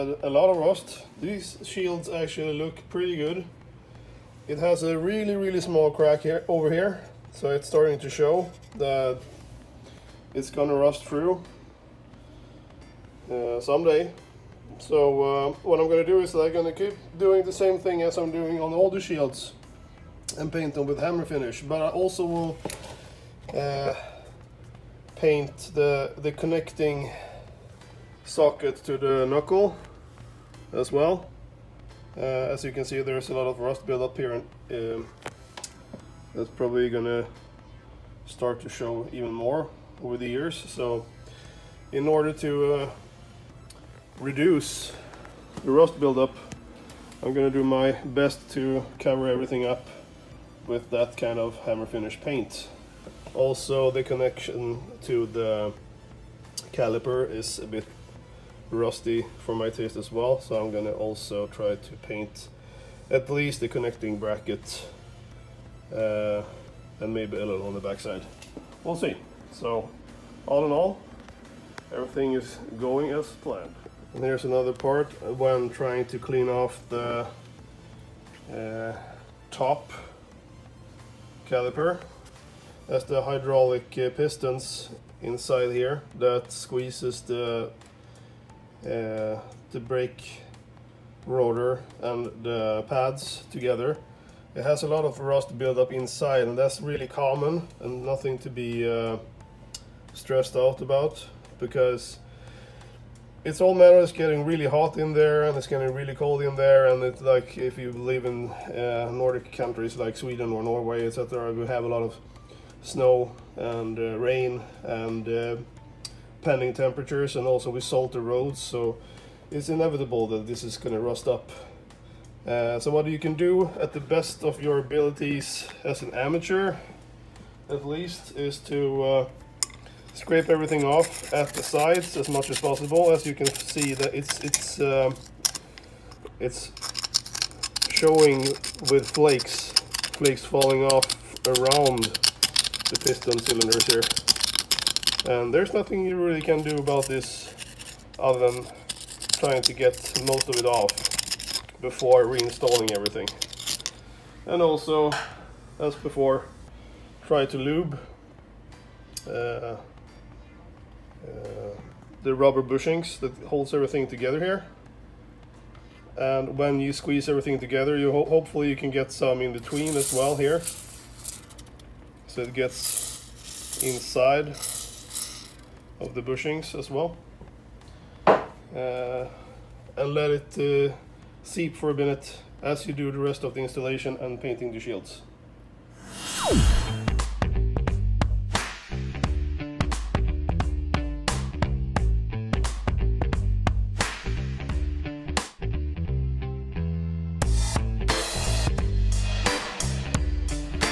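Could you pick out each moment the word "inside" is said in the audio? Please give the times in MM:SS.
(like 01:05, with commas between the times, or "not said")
01:25, 01:35, 02:53.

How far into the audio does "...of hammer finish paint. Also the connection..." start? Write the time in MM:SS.
00:51.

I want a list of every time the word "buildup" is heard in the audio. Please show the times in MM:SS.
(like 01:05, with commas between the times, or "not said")
00:33, 00:46, 01:35.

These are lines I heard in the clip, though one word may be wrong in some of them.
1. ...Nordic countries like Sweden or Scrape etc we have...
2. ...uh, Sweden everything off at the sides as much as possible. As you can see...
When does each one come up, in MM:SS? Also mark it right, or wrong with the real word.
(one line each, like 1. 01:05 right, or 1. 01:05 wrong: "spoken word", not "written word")
1. 01:49 wrong: "Norway", not "Scrape"
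2. 02:09 wrong: "Scrape", not "Sweden".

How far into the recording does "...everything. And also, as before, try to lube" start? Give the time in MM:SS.
02:32.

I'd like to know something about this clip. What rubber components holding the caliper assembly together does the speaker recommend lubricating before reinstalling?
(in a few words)
rubber bushings.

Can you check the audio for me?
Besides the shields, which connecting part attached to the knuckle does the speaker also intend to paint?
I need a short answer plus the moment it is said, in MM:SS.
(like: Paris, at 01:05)
connecting socket, at 00:26.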